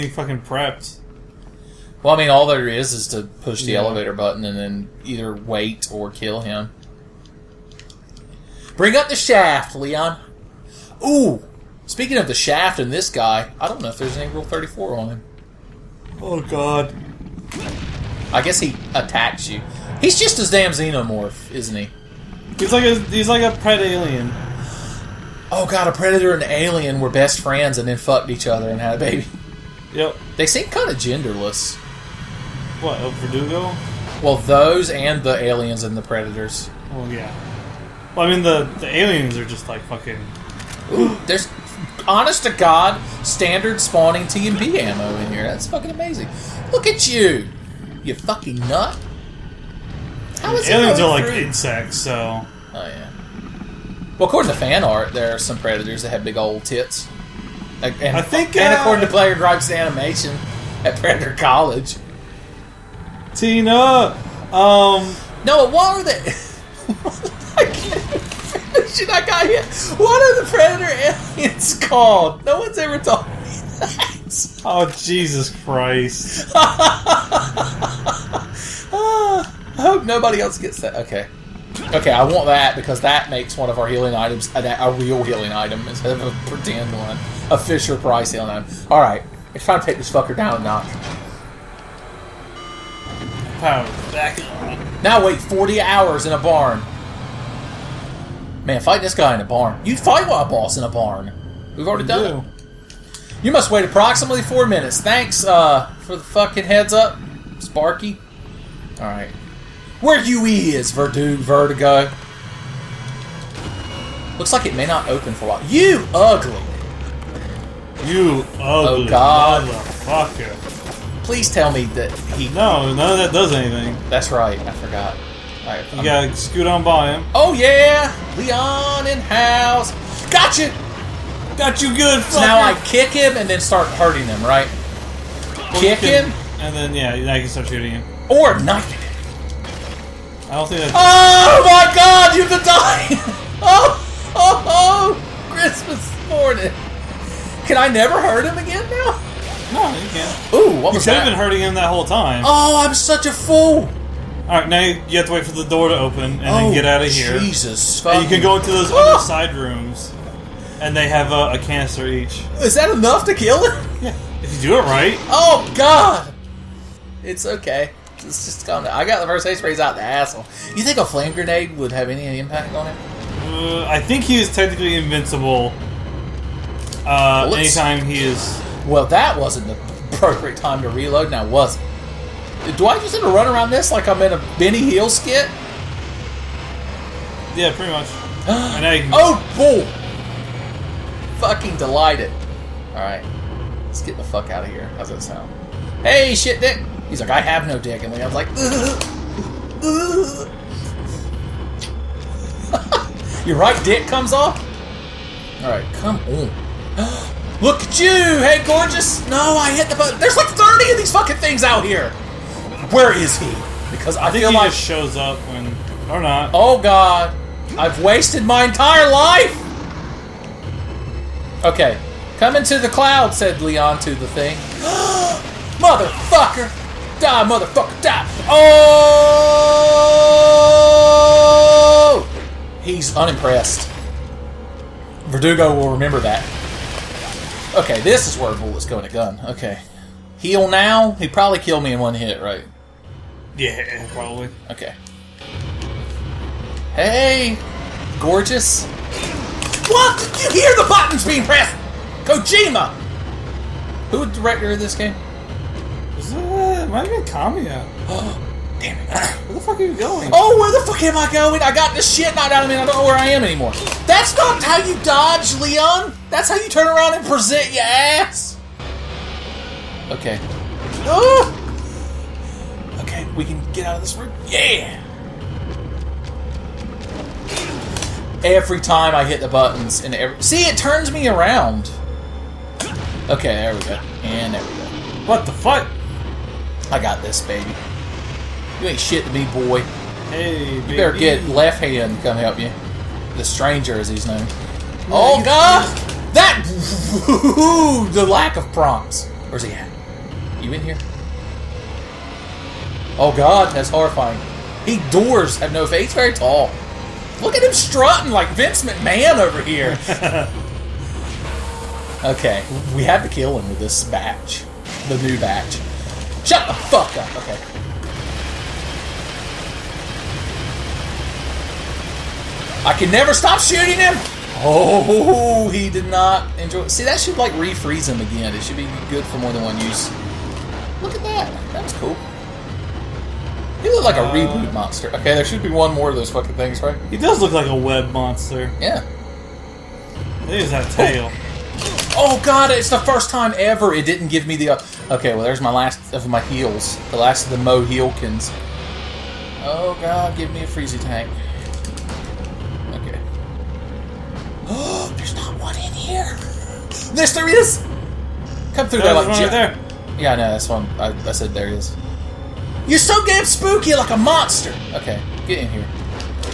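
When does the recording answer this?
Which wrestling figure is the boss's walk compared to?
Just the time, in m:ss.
5:08.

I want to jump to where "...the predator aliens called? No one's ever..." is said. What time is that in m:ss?
1:10.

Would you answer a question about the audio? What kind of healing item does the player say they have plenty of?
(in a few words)
first aid sprays.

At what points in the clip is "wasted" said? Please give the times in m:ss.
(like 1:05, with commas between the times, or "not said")
3:38.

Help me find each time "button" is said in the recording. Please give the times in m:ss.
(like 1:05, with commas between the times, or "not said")
0:04, 3:29, 4:10, 4:39.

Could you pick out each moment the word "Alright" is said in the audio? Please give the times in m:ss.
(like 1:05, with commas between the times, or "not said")
1:48, 2:34, 3:12, 3:25.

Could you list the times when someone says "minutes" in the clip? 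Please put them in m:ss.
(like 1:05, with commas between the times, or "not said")
1:44.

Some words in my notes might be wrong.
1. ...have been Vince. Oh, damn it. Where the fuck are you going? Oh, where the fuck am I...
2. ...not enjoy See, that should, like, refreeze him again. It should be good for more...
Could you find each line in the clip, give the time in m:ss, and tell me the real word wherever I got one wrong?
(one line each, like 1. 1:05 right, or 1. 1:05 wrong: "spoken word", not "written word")
1. 4:17 wrong: "Kamiya", not "Vince"
2. 5:26 right.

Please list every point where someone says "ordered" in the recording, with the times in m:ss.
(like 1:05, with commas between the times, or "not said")
not said.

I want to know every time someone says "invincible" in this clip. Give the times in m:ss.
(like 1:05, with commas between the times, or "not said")
2:54.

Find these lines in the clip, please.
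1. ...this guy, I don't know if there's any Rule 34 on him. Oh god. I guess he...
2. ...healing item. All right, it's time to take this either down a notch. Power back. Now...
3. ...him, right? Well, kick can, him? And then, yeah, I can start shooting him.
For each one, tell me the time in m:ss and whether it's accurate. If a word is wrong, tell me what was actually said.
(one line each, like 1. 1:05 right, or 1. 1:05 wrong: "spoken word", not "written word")
1. 0:12 right
2. 1:28 wrong: "fucker", not "either"
3. 2:14 right.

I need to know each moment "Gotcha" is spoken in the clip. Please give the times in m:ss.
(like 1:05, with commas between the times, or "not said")
2:10.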